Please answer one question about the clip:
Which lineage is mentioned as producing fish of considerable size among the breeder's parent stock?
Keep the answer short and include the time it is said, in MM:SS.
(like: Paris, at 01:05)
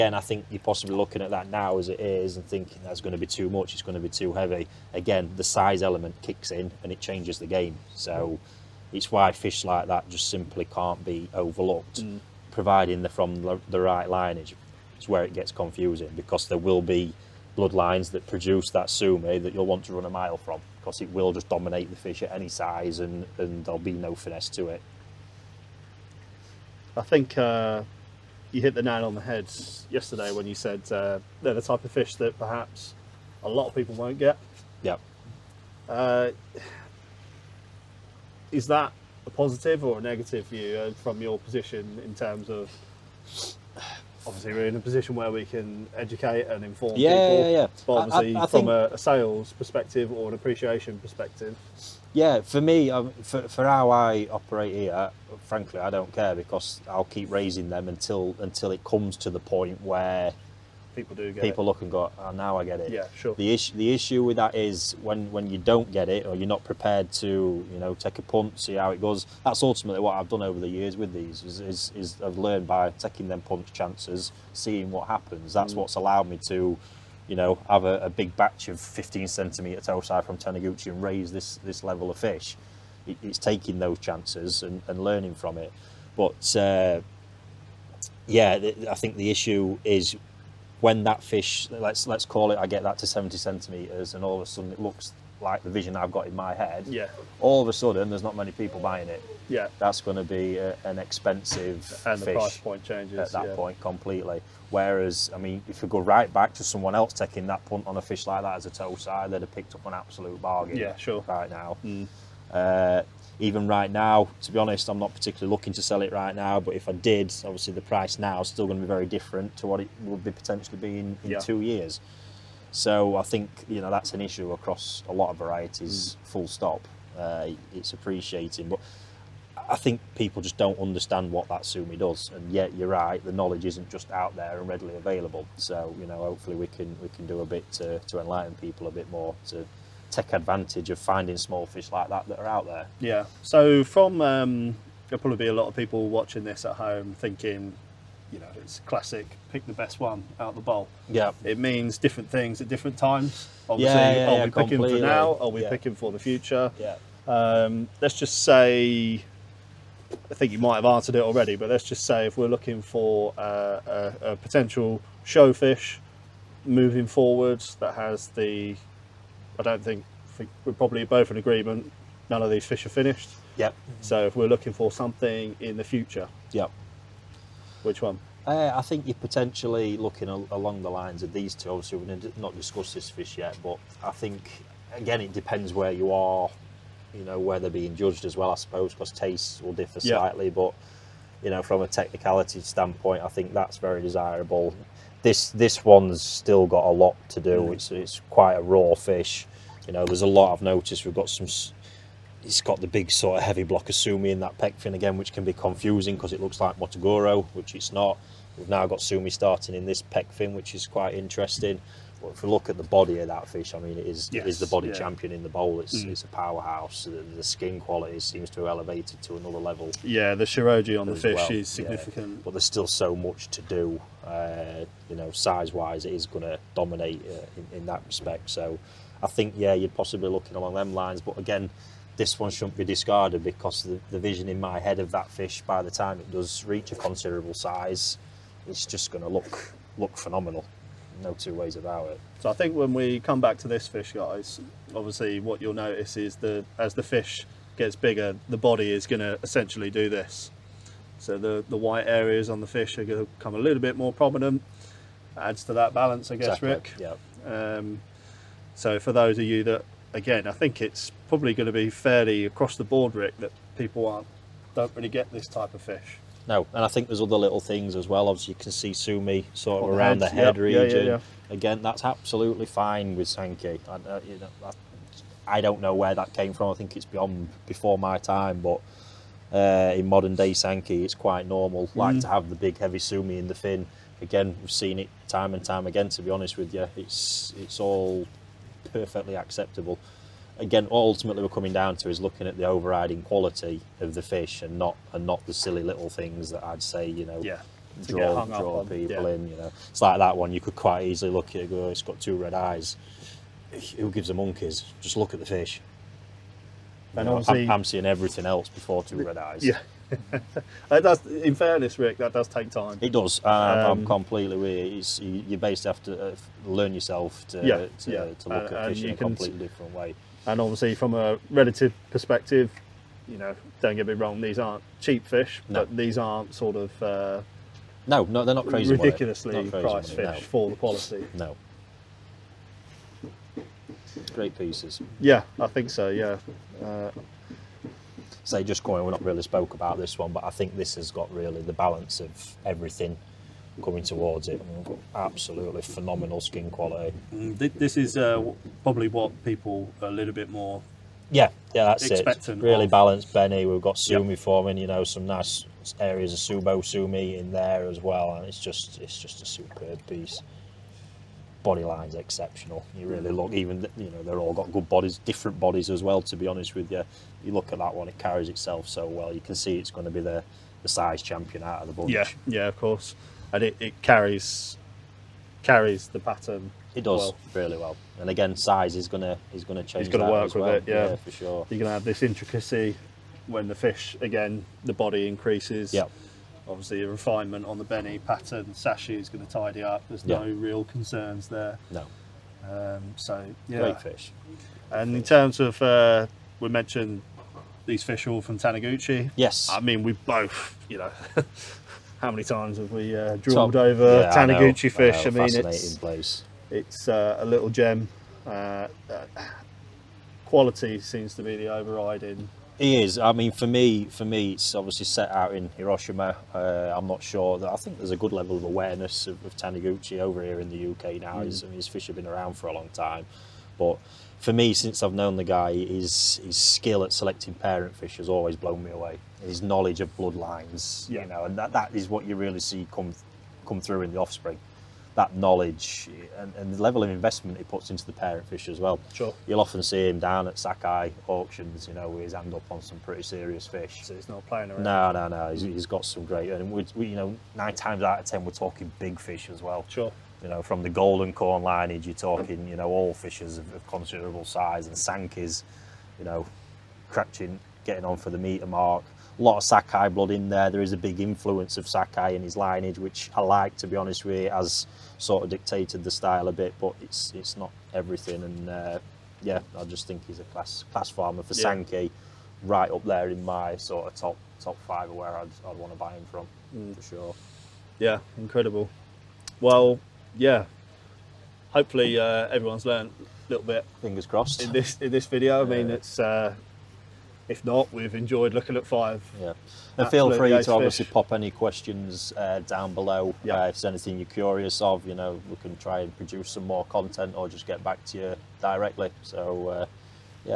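golden corn lineage, at 07:30.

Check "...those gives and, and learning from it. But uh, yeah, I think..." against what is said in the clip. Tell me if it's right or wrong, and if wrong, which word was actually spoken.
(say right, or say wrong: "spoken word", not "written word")
wrong: "chances", not "gives".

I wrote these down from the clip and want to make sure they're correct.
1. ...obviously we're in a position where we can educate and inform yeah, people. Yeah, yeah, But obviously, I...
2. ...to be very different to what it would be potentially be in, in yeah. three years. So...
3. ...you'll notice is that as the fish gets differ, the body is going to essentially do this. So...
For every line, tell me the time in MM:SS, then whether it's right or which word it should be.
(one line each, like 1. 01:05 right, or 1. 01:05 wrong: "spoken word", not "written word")
1. 00:44 right
2. 01:58 wrong: "two", not "three"
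3. 04:05 wrong: "bigger", not "differ".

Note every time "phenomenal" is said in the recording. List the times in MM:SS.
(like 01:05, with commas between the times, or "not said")
04:00, 05:45.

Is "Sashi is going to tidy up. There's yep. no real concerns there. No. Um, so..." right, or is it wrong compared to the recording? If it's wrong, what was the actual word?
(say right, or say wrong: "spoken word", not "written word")
right.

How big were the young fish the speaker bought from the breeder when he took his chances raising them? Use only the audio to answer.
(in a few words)
15 centimeter.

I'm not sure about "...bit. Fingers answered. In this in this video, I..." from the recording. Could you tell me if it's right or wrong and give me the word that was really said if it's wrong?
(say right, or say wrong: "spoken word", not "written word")
wrong: "crossed", not "answered".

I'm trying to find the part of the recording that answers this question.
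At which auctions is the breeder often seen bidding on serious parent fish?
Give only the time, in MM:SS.
07:20.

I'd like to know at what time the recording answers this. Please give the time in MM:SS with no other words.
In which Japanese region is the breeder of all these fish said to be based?
06:55.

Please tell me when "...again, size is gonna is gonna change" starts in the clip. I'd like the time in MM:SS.
06:18.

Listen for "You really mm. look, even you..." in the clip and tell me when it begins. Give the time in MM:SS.
06:02.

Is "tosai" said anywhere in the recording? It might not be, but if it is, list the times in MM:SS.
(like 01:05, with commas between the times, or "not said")
01:19, 01:48.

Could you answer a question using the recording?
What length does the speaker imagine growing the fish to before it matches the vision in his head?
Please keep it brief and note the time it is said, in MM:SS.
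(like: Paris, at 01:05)
70 centimeters, at 01:33.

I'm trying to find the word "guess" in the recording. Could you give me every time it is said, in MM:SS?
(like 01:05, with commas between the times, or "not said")
04:16.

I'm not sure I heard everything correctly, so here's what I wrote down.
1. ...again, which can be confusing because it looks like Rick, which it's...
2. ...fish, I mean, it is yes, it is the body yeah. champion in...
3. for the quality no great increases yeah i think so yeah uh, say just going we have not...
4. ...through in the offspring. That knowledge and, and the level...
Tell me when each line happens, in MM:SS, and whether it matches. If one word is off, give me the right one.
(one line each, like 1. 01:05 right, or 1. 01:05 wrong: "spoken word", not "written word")
1. 03:24 wrong: "Motoguro", not "Rick"
2. 03:33 right
3. 05:30 wrong: "pieces", not "increases"
4. 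07:13 right.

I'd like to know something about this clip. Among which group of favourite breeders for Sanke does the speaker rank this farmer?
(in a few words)
top five.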